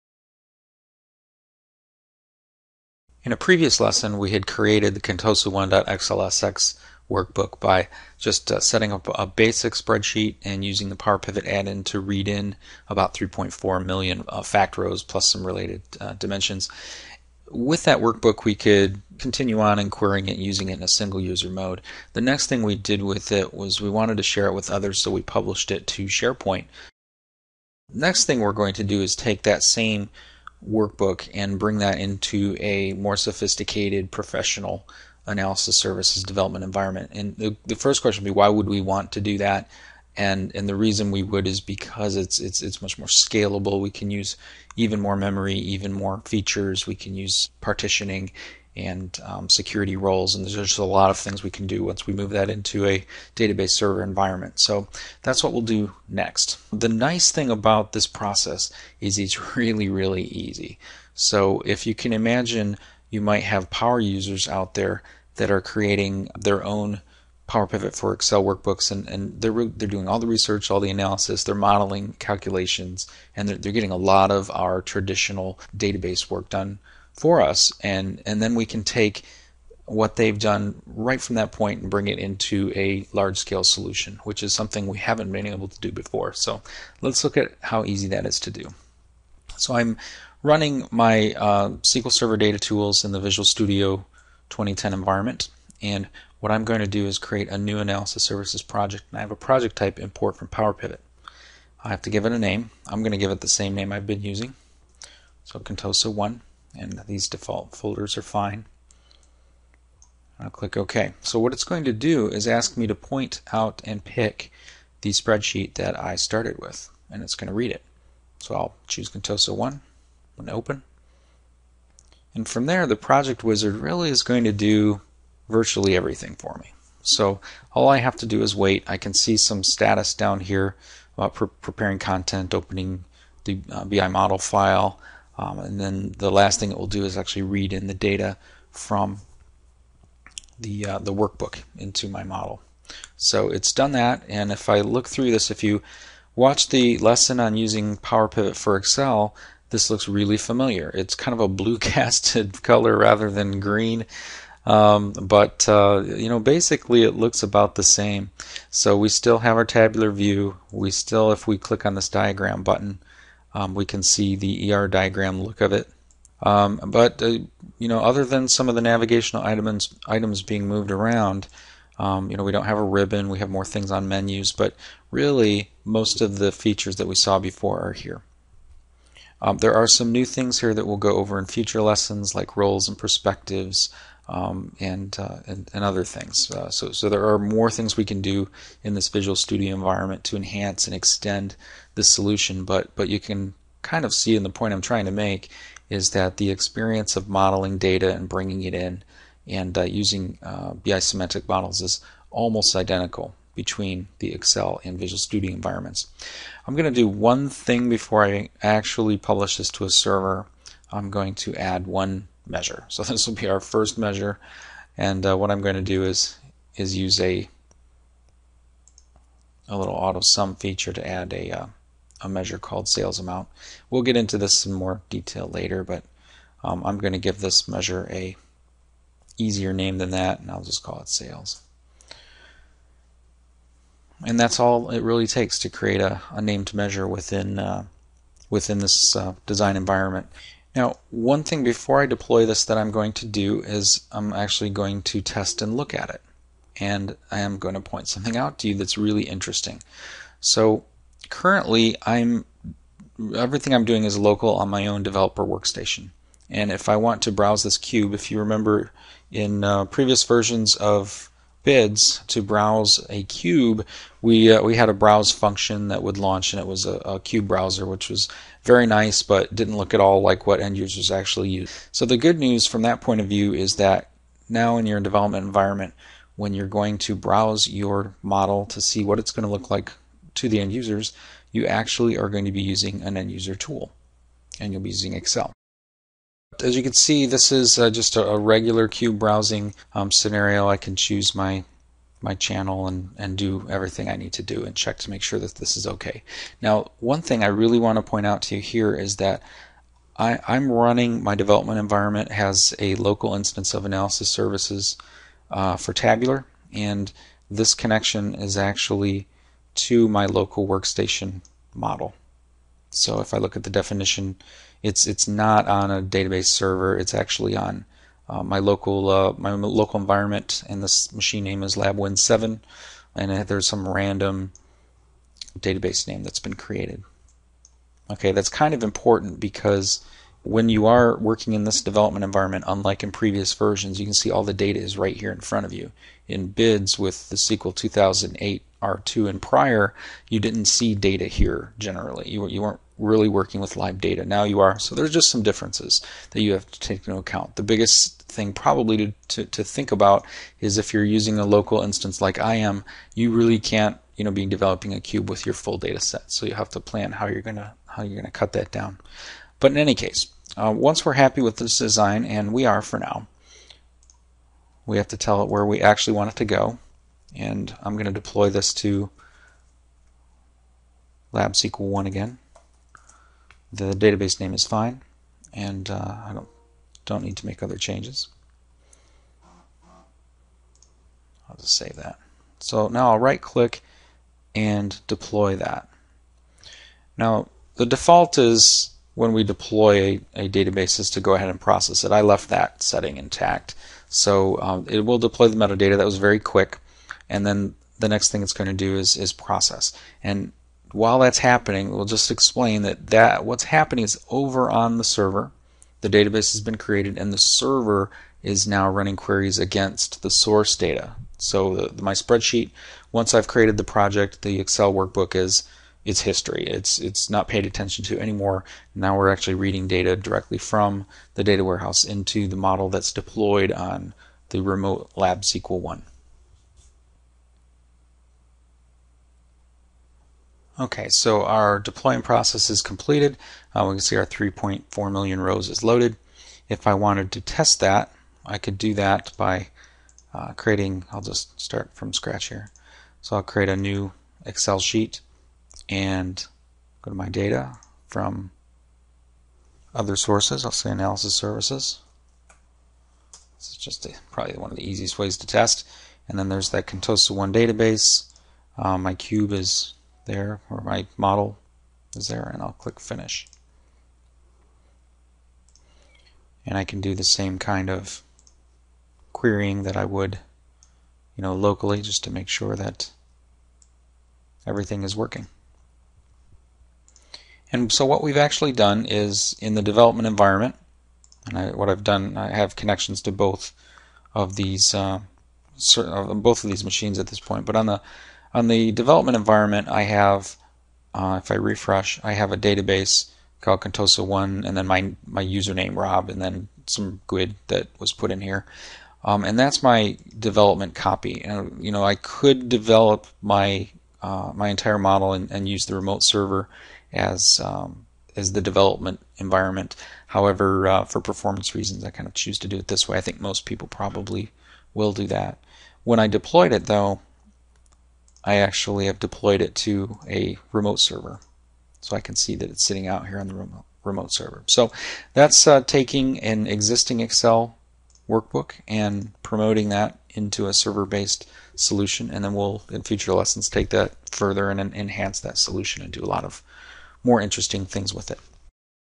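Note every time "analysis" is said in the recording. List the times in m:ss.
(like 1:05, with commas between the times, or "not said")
0:35, 1:10, 1:37, 5:03, 7:30.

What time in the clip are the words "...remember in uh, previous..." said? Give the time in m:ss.
4:18.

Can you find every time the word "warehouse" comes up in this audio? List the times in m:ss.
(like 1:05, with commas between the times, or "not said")
7:01.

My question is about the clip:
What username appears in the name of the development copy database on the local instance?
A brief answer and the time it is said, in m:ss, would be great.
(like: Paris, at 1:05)
Rob, at 8:15.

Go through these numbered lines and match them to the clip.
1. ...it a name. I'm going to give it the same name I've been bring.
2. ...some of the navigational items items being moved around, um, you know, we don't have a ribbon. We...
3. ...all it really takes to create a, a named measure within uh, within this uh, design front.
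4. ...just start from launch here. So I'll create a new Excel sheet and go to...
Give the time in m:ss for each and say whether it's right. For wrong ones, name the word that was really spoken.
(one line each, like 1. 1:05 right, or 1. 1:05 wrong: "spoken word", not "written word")
1. 1:42 wrong: "using", not "bring"
2. 2:48 right
3. 3:54 wrong: "environment", not "front"
4. 7:21 wrong: "scratch", not "launch".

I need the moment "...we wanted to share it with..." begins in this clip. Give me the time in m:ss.
0:23.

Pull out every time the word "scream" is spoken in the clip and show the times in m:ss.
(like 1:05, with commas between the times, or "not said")
not said.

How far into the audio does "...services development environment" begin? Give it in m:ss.
0:35.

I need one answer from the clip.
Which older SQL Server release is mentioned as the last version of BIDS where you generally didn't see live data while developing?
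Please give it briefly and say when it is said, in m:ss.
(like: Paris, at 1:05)
SQL 2008 R2, at 5:37.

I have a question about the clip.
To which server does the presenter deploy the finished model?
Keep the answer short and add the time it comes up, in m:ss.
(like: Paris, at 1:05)
Lab SQL 1, at 6:11.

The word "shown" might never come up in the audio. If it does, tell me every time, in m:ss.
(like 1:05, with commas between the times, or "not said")
not said.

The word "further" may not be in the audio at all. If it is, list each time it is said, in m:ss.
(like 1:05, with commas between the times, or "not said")
8:54.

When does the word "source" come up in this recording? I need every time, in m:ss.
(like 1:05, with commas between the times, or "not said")
6:50, 7:30.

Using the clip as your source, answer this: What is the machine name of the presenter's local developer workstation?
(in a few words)
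LabWin7.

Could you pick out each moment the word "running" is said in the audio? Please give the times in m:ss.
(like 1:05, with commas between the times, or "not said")
1:30, 5:00, 6:48.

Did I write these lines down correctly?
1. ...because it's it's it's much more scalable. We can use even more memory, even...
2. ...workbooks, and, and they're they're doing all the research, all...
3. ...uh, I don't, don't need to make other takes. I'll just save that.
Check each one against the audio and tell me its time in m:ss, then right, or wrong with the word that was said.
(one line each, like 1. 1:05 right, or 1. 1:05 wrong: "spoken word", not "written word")
1. 0:41 right
2. 1:08 right
3. 6:15 wrong: "changes", not "takes".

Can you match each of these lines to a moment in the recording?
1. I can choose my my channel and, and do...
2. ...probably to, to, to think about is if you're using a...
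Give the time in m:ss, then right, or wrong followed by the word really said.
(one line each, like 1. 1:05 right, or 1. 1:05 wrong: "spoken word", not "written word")
1. 4:50 right
2. 5:48 right.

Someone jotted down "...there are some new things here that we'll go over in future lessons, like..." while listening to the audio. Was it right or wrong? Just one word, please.
right.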